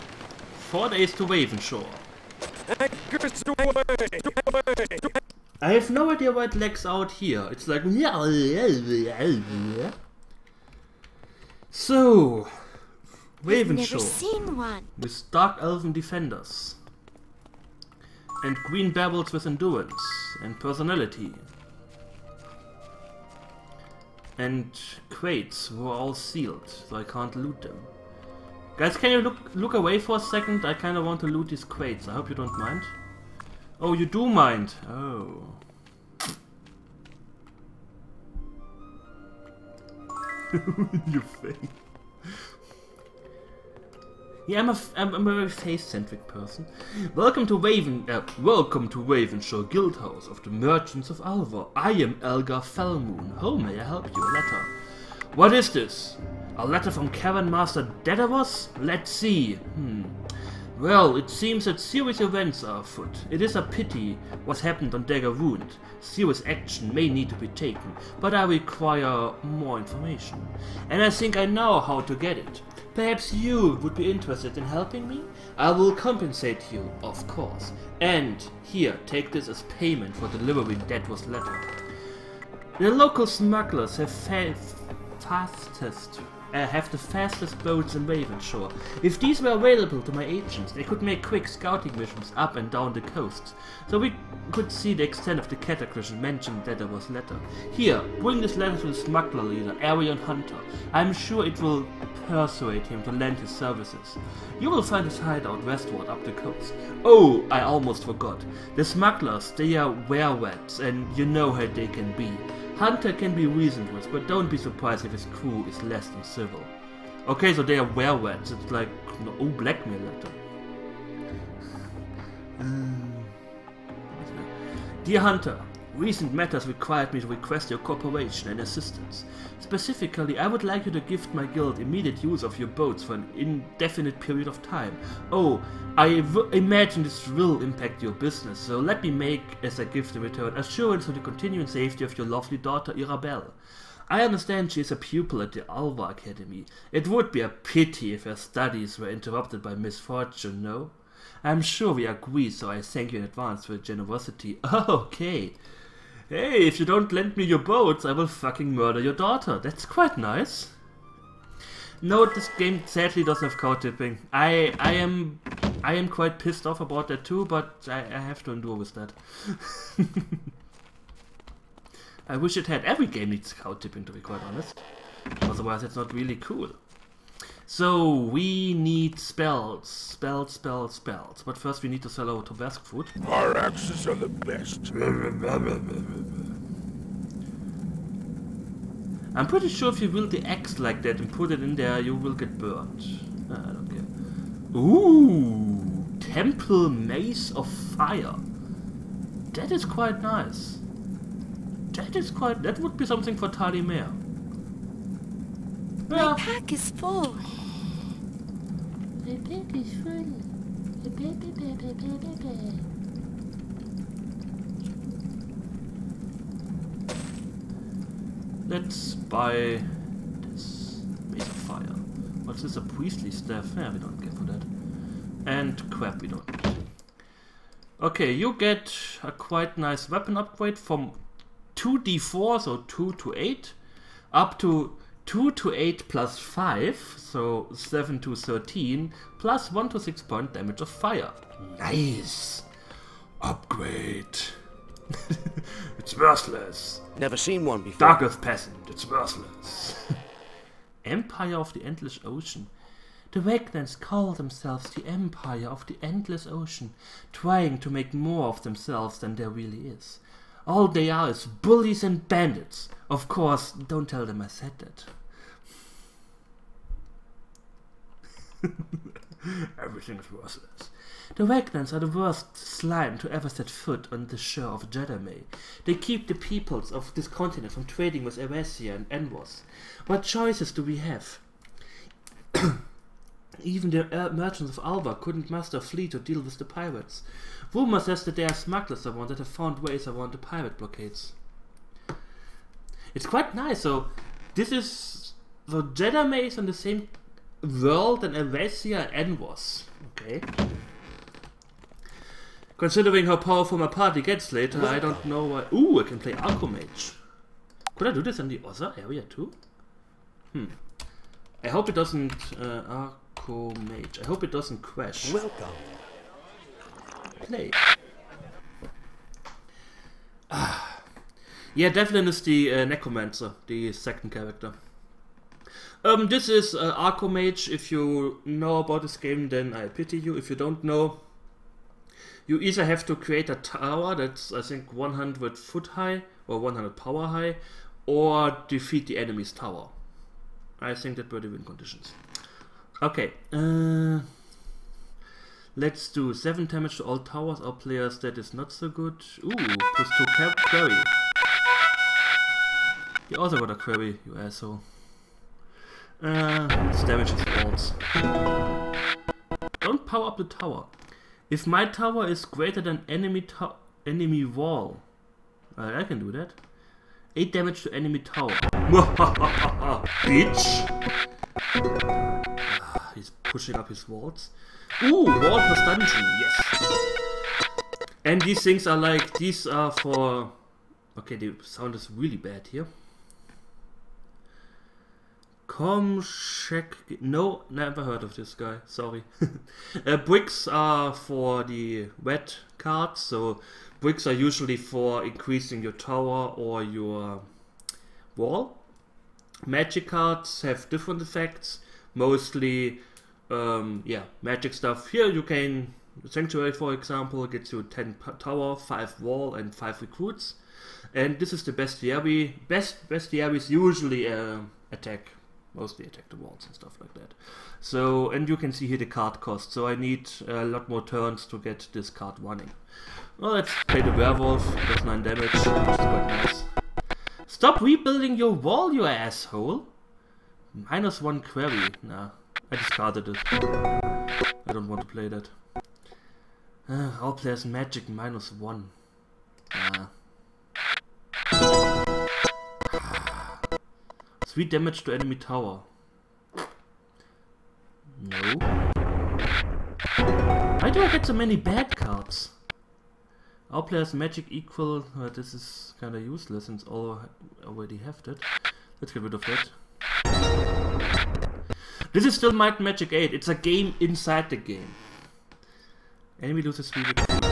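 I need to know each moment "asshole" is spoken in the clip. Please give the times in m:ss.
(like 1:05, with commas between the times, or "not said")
5:54, 7:09.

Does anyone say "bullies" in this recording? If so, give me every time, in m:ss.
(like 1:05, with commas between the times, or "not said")
4:21.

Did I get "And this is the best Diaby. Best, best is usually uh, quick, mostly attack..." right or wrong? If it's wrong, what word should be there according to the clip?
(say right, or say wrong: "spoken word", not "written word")
wrong: "attack", not "quick".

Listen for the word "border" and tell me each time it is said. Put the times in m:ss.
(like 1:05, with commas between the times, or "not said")
not said.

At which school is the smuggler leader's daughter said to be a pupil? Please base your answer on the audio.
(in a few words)
Alva Academy.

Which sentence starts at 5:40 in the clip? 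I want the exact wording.
I think that were the win conditions.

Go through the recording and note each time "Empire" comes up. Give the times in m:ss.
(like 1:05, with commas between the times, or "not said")
4:11, 4:15.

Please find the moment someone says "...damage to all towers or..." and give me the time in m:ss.
5:46.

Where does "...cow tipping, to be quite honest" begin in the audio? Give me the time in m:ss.
2:53.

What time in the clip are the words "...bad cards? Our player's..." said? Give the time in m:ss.
7:31.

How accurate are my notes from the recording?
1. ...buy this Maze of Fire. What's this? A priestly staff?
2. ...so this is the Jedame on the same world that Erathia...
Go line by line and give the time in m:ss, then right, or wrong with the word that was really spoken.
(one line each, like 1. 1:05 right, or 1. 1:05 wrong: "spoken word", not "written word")
1. 3:39 right
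2. 4:53 right.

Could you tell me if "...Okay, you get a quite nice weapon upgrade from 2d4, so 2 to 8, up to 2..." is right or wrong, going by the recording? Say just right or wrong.
right.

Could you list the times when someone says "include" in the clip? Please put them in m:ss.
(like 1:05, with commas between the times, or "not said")
not said.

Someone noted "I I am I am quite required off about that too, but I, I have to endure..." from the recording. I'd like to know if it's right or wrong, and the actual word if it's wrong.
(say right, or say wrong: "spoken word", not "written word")
wrong: "pissed", not "required".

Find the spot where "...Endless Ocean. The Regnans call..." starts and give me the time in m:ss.
4:11.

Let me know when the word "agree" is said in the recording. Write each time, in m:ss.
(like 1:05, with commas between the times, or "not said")
2:32.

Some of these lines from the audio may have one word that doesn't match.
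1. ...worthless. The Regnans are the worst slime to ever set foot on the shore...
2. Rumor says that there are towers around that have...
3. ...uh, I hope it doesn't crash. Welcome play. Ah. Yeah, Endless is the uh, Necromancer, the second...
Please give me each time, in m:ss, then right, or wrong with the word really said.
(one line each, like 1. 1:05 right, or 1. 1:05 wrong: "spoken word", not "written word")
1. 4:30 right
2. 4:47 wrong: "smugglers", not "towers"
3. 5:12 wrong: "Devlin", not "Endless".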